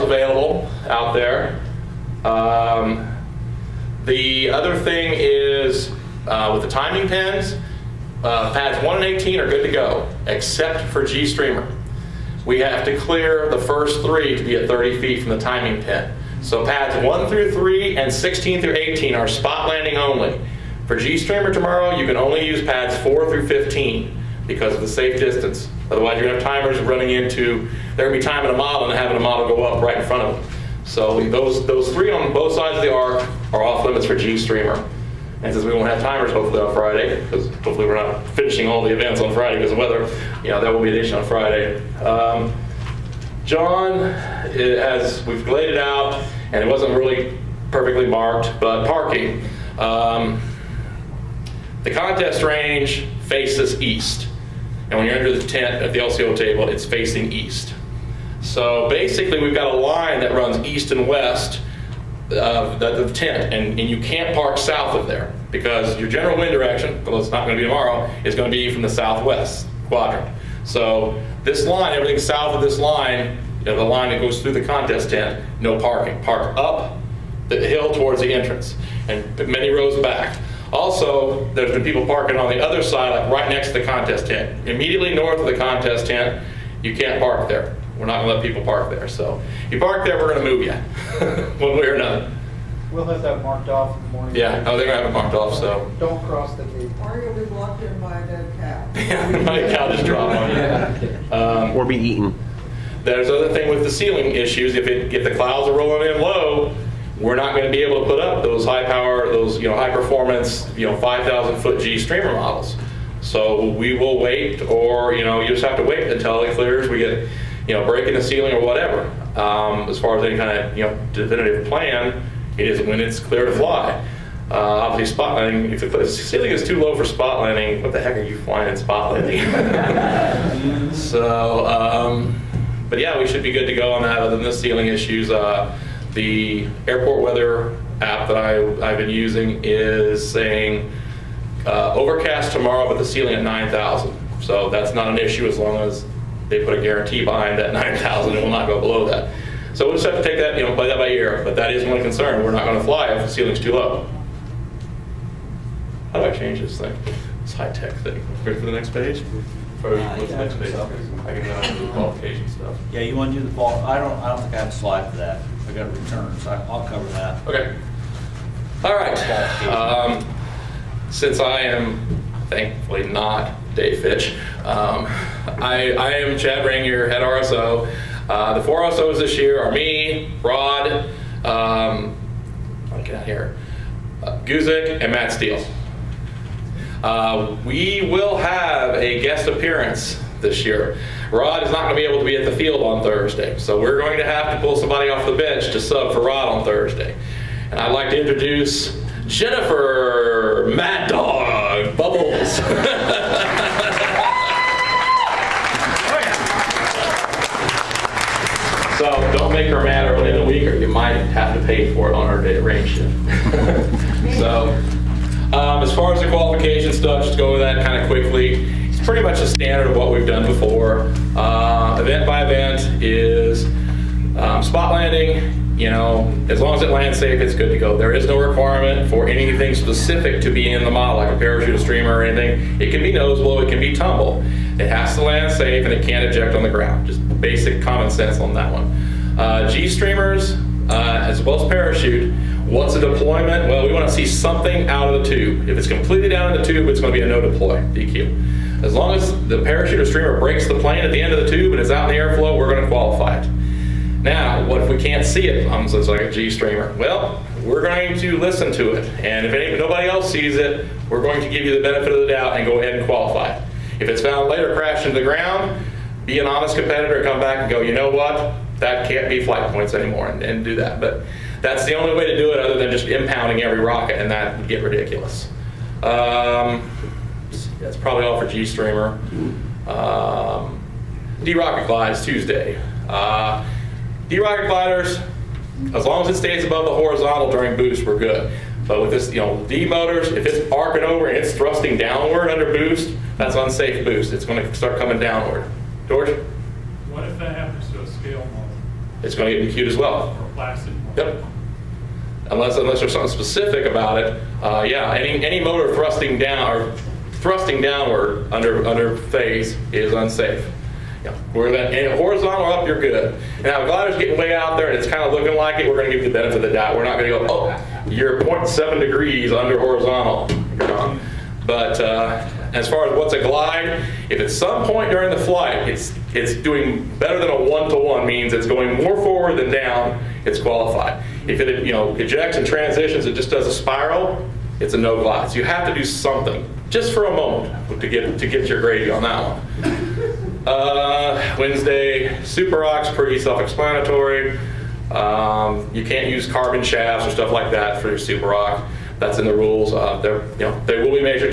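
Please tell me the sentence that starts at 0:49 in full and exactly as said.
Um, the contest range faces east.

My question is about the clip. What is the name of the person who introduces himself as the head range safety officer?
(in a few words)
Chad Ranger.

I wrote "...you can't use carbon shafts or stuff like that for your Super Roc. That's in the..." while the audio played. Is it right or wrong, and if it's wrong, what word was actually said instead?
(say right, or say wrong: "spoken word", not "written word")
right.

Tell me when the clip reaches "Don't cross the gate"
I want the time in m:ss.
1:35.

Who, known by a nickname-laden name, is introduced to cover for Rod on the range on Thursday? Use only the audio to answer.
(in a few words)
Jennifer Mad Dog Bubbles.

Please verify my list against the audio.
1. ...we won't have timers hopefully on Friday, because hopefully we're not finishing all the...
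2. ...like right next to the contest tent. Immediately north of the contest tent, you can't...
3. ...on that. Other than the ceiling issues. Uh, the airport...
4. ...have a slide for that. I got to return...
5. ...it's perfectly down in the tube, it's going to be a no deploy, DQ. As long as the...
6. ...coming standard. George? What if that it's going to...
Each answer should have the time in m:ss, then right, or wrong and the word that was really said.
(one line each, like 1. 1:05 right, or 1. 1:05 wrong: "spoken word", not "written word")
1. 0:35 right
2. 1:23 right
3. 2:13 right
4. 2:44 right
5. 4:05 wrong: "completely", not "perfectly"
6. 4:54 wrong: "downward", not "standard".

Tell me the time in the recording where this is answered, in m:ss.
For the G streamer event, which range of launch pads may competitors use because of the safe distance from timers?
0:22.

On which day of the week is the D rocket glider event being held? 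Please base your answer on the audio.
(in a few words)
Tuesday.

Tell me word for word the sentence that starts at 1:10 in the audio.
So this line, everything south of this line, you know, the line that goes through the contest tent, no parking.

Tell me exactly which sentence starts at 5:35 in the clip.
So you have to do something just for a moment to get to get your grade on that one.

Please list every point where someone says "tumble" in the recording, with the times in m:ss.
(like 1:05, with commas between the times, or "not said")
3:53.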